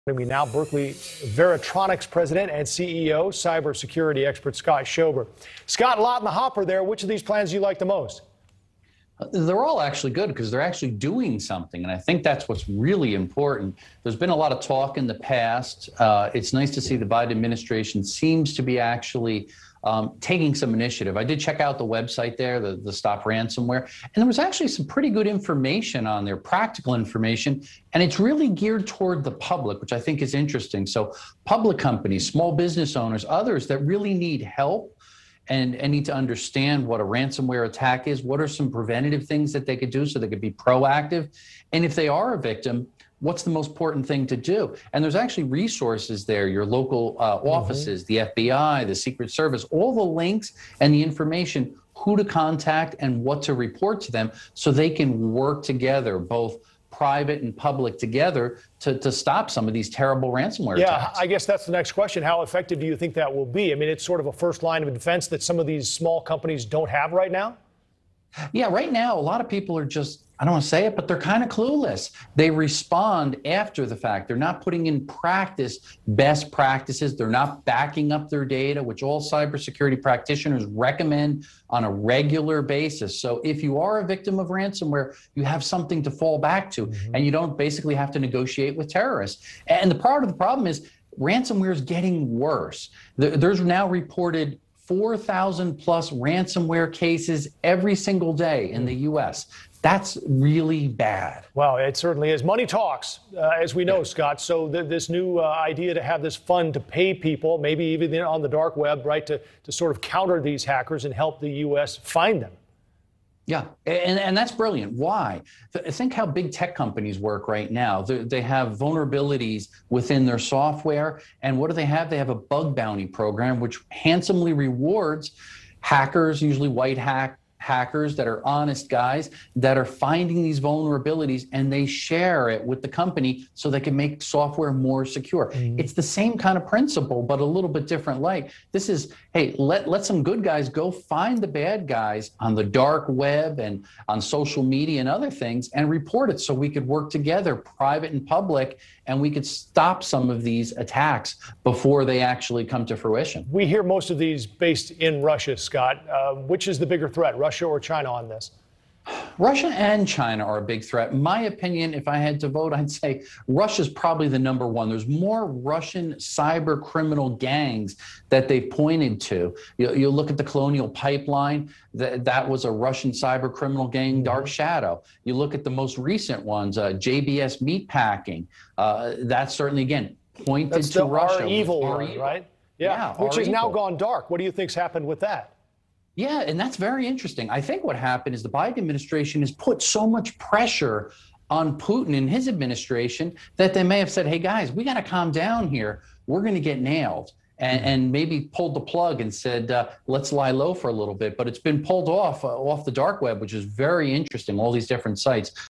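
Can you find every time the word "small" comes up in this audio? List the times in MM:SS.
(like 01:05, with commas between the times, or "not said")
00:32, 01:05.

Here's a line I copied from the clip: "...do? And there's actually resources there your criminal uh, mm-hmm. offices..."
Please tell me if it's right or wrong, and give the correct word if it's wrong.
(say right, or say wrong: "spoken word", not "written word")
wrong: "local", not "criminal".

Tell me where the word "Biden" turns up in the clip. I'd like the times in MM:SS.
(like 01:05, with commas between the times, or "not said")
00:17, 03:08.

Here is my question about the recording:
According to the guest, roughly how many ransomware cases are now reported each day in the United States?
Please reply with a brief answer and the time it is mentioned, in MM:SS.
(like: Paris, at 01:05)
4,000 plus, at 01:34.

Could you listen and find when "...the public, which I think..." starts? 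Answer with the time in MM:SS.
00:29.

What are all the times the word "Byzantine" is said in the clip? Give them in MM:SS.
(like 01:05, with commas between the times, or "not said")
not said.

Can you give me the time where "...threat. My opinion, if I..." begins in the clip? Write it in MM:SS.
02:40.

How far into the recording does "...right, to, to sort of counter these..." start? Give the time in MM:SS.
01:49.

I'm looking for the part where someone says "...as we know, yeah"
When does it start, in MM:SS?
01:43.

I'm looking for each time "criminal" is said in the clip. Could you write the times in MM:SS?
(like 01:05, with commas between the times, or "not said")
02:46, 02:53.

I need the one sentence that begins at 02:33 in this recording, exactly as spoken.
We hear most of these based in Russia, Scott.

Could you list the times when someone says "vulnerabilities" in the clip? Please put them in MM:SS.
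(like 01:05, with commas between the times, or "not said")
01:58, 02:10.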